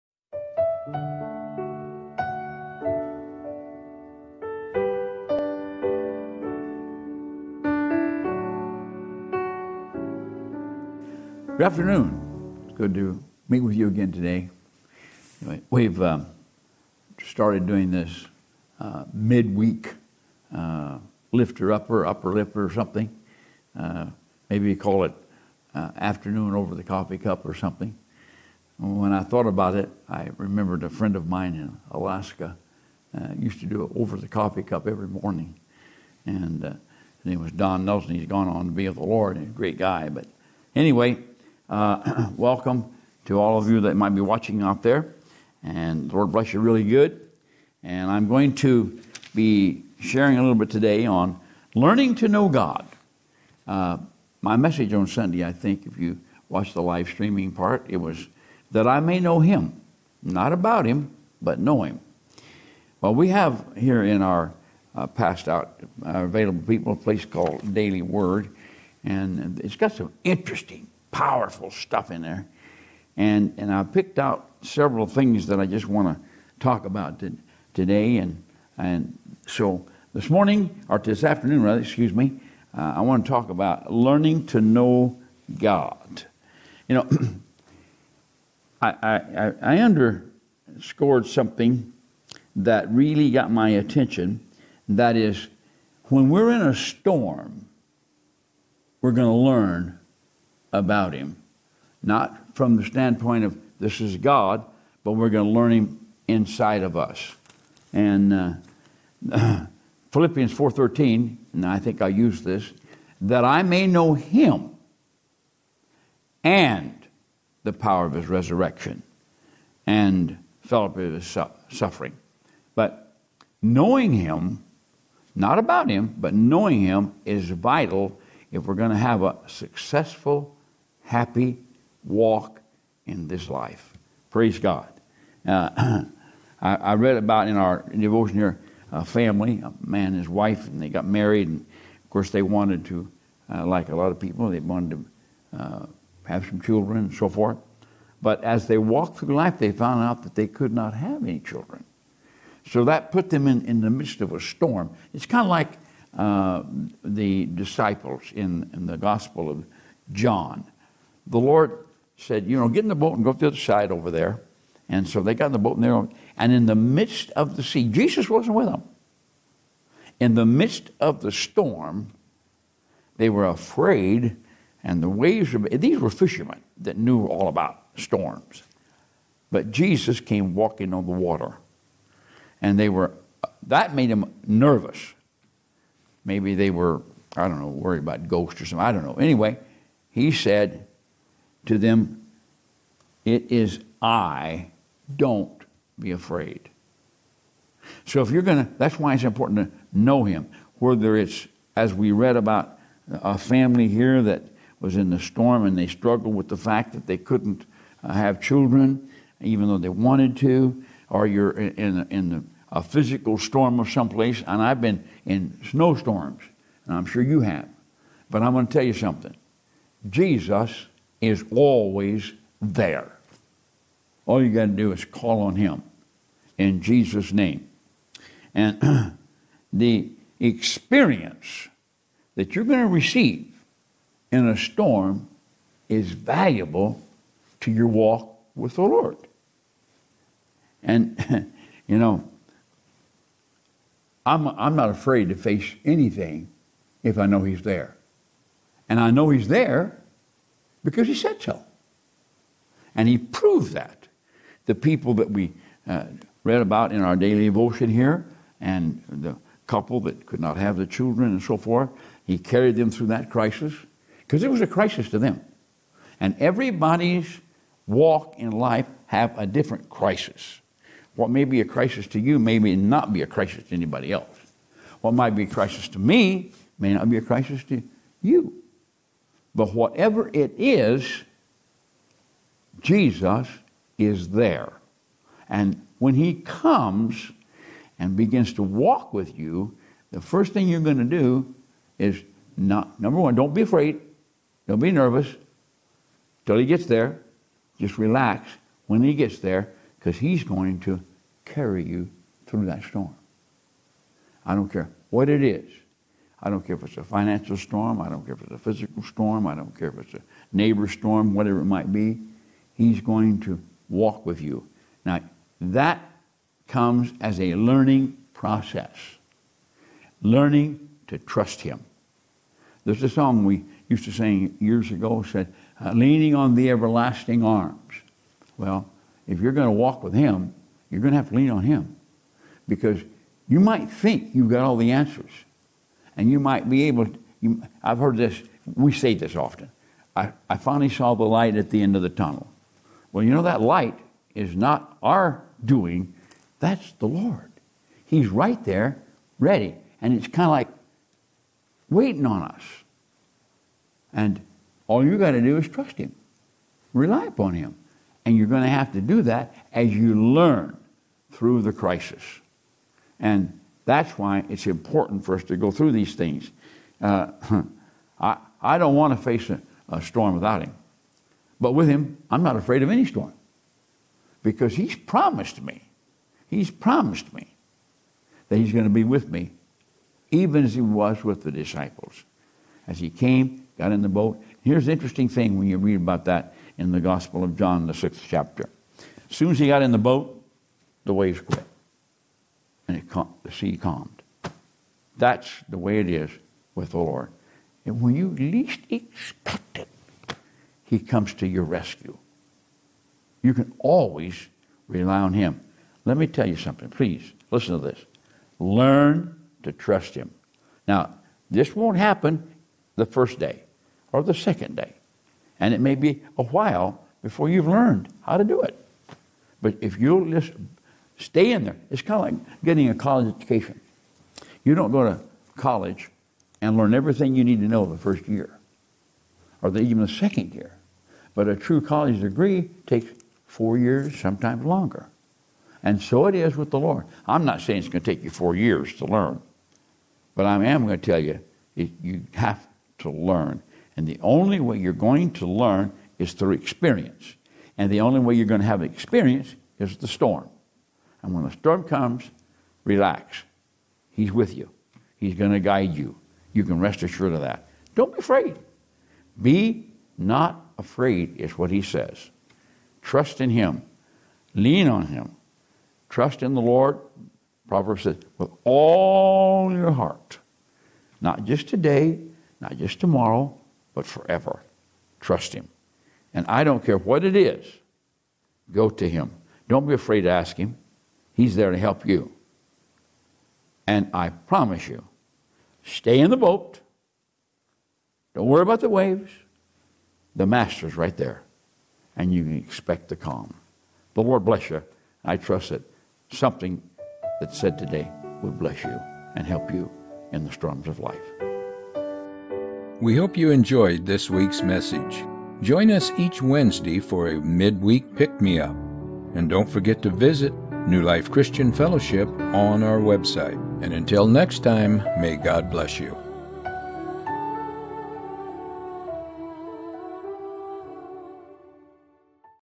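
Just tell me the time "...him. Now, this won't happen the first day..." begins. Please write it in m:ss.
6:50.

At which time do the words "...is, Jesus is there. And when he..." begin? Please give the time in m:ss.
4:40.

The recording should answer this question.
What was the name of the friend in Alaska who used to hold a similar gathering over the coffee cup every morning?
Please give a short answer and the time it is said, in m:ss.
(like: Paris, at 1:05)
Don Nelson, at 0:37.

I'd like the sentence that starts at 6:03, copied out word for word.
And that's why it's important for us to go through these things.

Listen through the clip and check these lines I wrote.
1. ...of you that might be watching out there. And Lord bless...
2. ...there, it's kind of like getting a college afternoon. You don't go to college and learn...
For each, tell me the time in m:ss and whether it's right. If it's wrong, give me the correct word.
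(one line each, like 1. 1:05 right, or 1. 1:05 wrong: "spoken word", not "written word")
1. 0:43 right
2. 7:01 wrong: "education", not "afternoon".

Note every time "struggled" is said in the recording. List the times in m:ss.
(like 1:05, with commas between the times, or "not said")
3:25.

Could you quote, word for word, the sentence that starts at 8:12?
And you can expect the calm.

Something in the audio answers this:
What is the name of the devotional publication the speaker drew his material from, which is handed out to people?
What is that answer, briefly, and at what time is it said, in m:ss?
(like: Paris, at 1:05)
Daily Word, at 1:07.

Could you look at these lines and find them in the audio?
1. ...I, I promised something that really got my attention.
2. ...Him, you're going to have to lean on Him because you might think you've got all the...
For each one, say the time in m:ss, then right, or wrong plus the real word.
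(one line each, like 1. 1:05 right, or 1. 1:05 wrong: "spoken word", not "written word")
1. 1:29 wrong: "underscored", not "promised"
2. 5:30 right.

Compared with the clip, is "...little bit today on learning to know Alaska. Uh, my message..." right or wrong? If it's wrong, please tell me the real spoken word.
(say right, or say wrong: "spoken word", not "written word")
wrong: "God", not "Alaska".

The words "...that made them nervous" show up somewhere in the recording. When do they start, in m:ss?
3:03.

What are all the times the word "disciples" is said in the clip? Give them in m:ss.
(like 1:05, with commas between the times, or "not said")
2:37, 6:21.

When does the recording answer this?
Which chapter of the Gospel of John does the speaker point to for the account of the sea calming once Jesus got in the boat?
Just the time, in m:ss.
6:27.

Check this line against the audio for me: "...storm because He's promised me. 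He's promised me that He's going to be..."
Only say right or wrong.
right.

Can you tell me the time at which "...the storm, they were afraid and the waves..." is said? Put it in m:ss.
2:51.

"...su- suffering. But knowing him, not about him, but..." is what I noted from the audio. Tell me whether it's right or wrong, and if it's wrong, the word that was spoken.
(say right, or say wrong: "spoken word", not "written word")
right.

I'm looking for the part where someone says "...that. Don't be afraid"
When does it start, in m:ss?
7:37.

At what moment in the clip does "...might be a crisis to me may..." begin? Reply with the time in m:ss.
4:35.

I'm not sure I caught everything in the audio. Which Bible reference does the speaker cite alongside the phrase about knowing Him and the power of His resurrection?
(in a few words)
Philippians 4:13.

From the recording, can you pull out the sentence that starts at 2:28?
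But as they walked through life, they found out that they could not have any children.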